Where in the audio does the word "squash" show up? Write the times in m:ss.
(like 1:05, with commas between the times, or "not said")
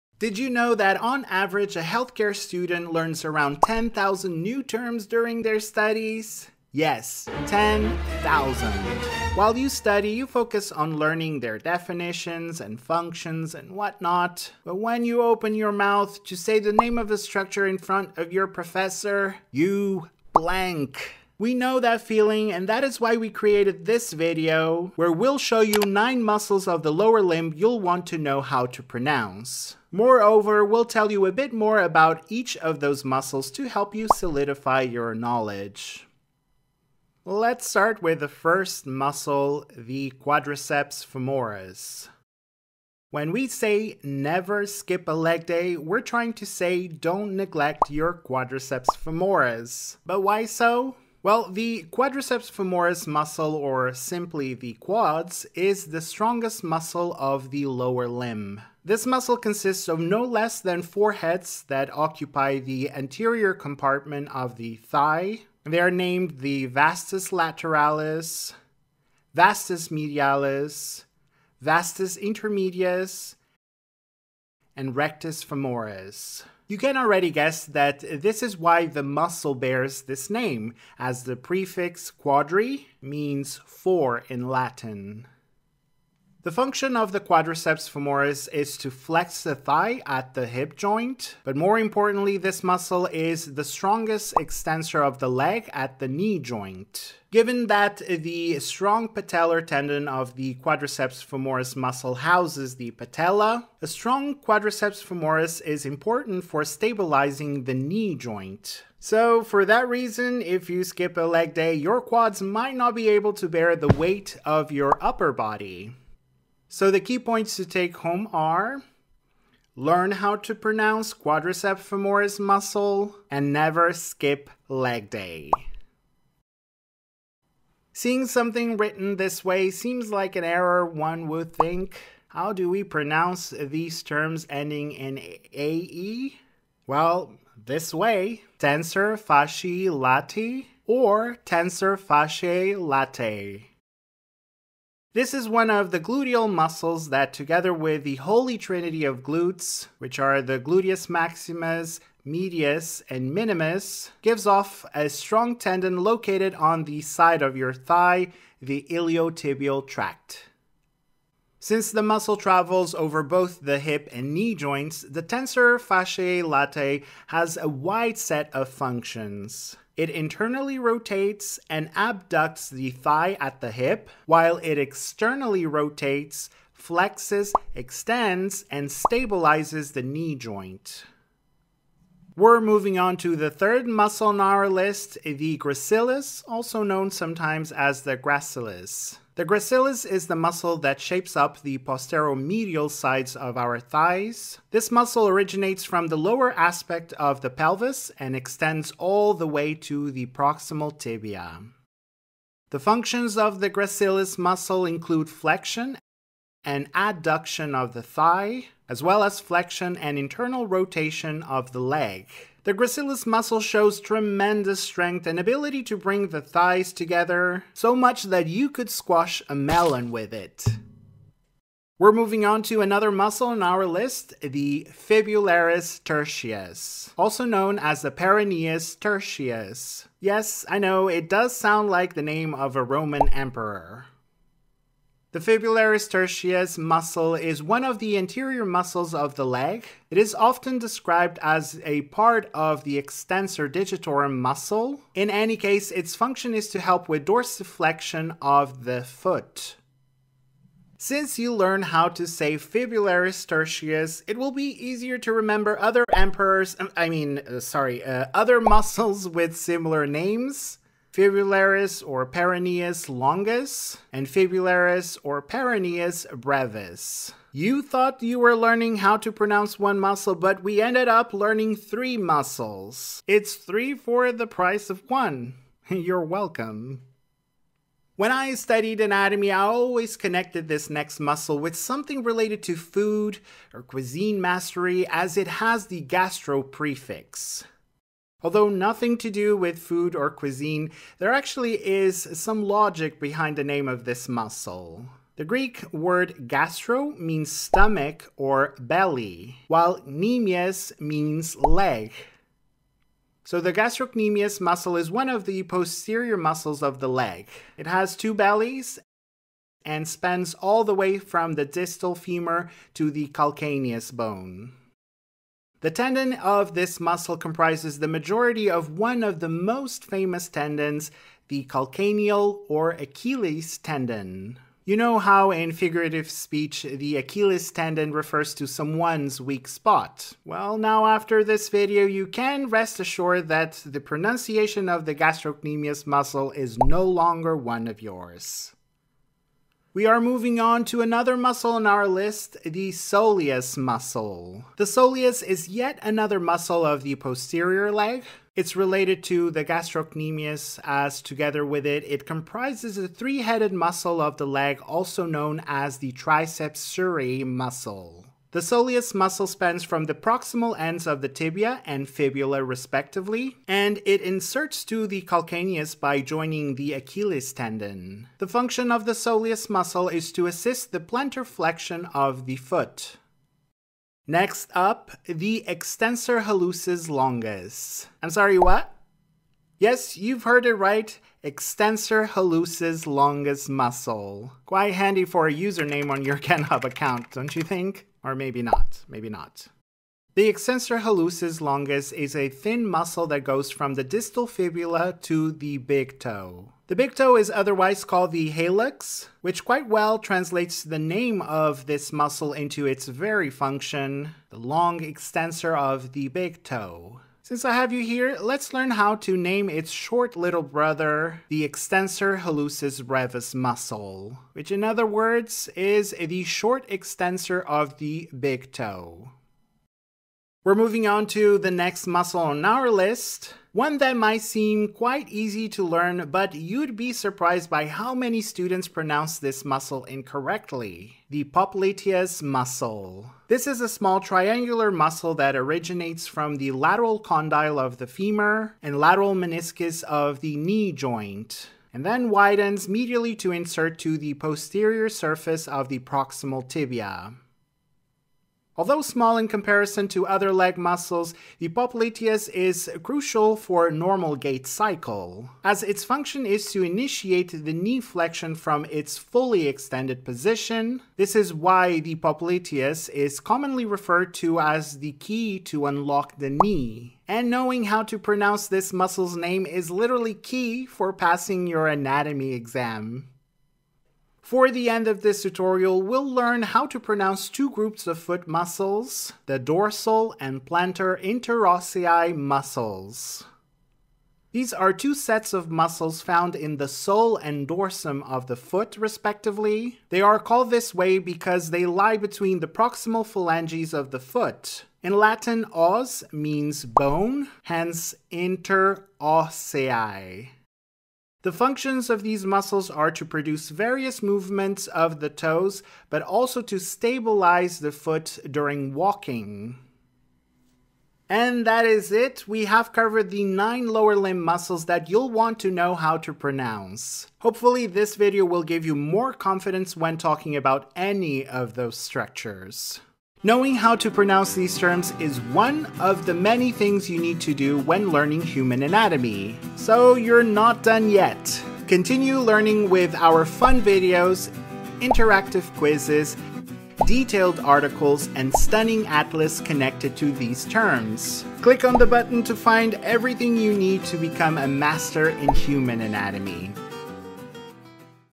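3:38.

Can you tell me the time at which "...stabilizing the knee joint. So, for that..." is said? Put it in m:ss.
1:46.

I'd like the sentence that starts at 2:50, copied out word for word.
It internally rotates and abducts the thigh at the hip, while it externally rotates, flexes, extends, and stabilizes the knee joint.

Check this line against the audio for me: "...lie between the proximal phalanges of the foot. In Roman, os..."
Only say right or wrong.
wrong.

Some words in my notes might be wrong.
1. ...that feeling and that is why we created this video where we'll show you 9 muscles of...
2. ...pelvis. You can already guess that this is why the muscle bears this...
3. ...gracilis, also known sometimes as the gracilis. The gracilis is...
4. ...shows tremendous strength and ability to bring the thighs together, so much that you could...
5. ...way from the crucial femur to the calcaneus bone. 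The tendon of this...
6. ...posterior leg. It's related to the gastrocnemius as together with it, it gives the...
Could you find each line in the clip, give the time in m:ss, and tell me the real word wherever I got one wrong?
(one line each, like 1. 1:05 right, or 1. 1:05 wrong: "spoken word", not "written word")
1. 0:21 right
2. 1:15 wrong: "femoris", not "pelvis"
3. 3:05 right
4. 3:33 right
5. 5:10 wrong: "distal", not "crucial"
6. 5:47 wrong: "comprises", not "gives".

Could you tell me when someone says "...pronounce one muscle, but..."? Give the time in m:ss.
4:29.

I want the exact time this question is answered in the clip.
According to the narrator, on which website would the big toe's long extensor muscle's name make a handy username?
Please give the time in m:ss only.
6:26.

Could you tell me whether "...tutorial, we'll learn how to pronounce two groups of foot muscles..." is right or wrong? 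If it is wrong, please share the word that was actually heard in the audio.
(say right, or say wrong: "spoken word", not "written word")
right.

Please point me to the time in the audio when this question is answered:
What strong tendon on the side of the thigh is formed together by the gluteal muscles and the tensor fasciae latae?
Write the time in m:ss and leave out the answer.
2:38.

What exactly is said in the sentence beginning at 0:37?
Let's start with the first muscle, the quadriceps femoris.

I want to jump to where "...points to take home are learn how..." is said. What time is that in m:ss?
1:57.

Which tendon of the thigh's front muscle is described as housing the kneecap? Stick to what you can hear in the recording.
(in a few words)
patellar tendon.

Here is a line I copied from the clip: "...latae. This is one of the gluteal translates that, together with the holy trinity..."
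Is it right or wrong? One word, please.
wrong.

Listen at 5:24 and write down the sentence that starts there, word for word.
You know how in figurative speech the Achilles tendon refers to someone's weak spot.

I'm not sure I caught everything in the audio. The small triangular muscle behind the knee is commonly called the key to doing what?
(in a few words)
unlock the knee.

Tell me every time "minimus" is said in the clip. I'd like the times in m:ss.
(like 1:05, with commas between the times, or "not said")
2:33.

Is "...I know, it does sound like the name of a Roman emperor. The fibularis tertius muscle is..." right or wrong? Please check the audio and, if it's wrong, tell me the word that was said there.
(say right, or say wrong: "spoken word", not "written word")
right.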